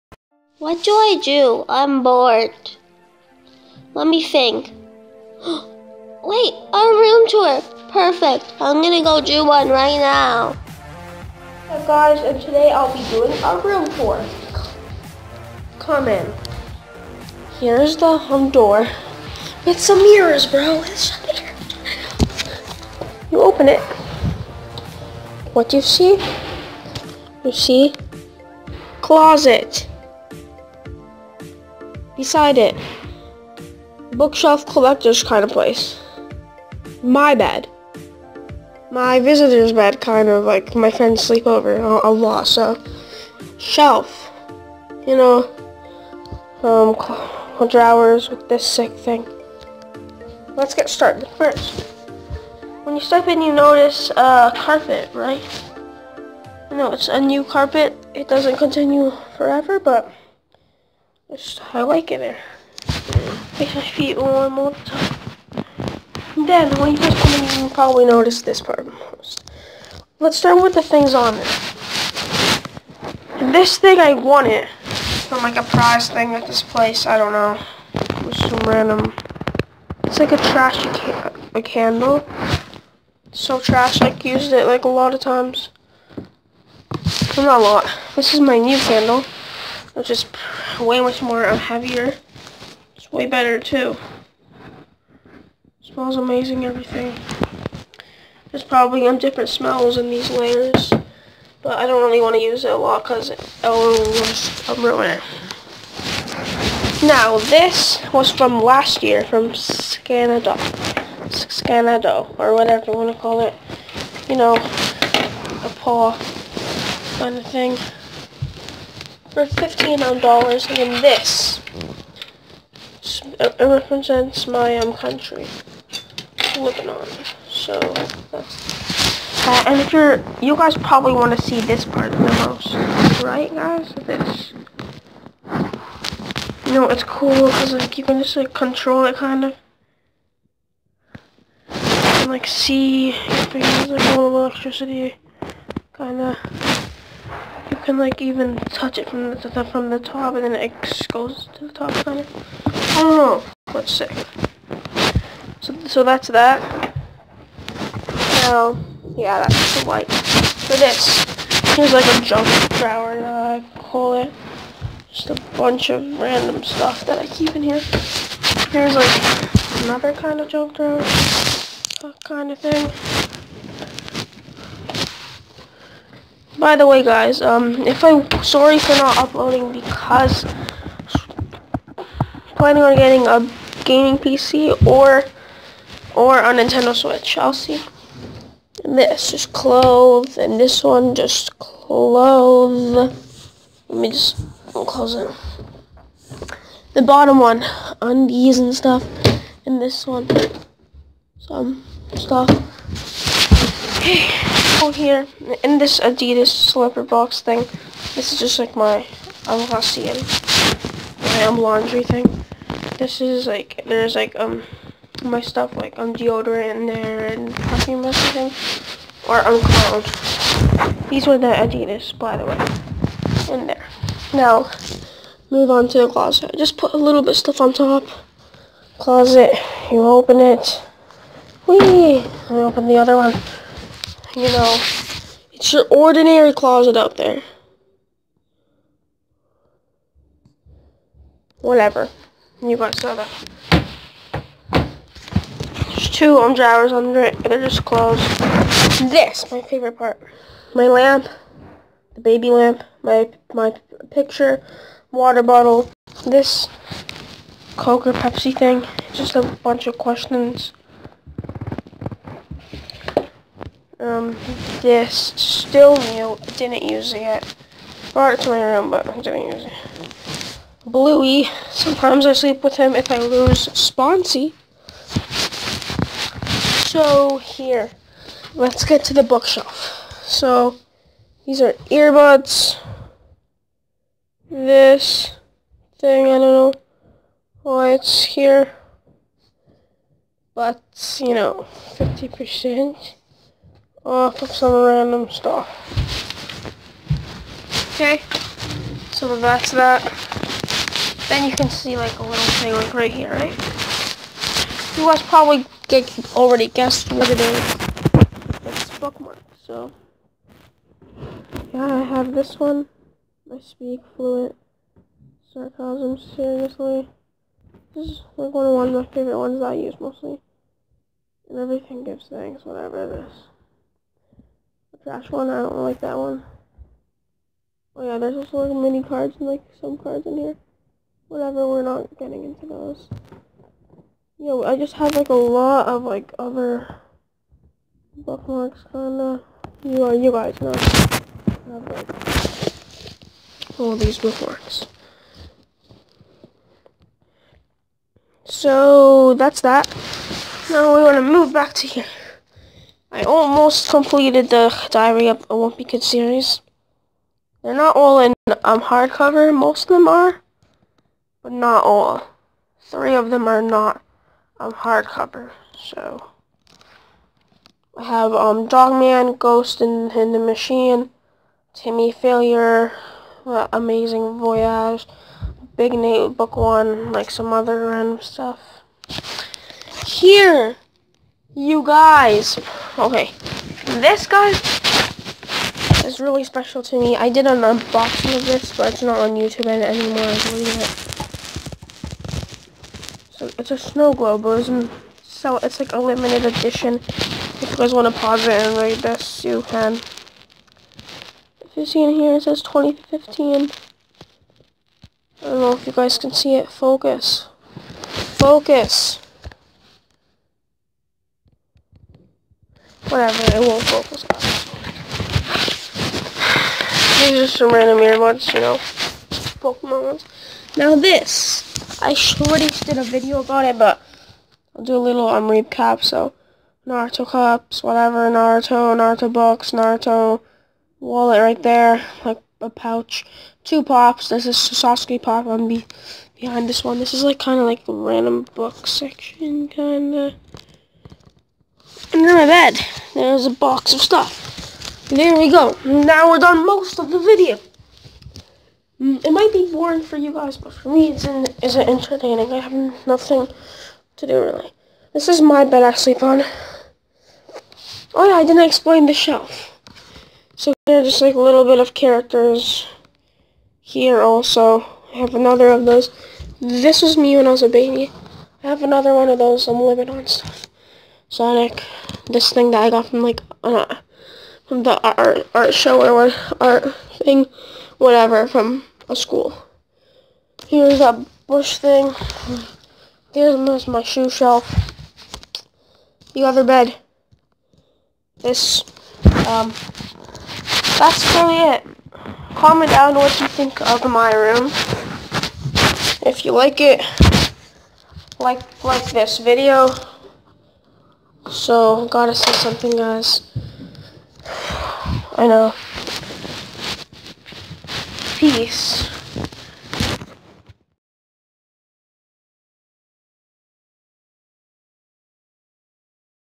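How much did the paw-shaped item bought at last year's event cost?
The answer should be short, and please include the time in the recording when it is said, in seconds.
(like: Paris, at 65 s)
$15, at 119 s.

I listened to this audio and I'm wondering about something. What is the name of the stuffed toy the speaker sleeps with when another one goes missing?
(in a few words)
Bluey.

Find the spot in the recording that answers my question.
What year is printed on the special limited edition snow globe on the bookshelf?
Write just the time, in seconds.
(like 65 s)
402 s.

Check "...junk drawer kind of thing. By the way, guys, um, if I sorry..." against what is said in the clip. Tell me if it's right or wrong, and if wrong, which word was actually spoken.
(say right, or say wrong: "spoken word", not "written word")
right.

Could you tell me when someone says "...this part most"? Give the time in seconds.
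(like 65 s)
68 s.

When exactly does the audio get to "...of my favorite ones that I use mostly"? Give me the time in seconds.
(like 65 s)
318 s.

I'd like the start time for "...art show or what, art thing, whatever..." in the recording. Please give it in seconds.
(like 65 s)
475 s.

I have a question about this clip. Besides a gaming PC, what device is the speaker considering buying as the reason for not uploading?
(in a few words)
Nintendo Switch.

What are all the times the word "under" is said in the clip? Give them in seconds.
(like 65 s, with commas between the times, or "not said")
246 s, 442 s.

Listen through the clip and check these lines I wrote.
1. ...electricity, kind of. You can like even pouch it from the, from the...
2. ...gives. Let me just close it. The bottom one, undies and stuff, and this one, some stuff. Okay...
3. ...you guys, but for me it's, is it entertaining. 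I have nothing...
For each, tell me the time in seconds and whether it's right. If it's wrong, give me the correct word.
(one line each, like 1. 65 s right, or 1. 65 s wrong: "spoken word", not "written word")
1. 144 s wrong: "touch", not "pouch"
2. 191 s wrong: "clothes", not "gives"
3. 450 s right.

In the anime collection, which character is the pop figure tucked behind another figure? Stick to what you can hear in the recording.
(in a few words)
Sasuke.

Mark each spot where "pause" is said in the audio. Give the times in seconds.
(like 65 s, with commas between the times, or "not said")
398 s.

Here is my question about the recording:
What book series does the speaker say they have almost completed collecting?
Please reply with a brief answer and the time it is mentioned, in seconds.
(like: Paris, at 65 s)
Diary of a Wimpy Kid, at 354 s.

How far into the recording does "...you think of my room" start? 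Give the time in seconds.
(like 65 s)
493 s.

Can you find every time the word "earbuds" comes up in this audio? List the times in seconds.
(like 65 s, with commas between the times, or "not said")
281 s, 417 s.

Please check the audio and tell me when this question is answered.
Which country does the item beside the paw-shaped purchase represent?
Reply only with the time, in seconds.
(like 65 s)
126 s.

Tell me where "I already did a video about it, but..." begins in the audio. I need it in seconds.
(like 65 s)
422 s.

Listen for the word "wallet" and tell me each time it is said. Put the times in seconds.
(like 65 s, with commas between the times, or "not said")
431 s.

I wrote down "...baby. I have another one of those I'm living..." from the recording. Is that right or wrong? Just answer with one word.
right.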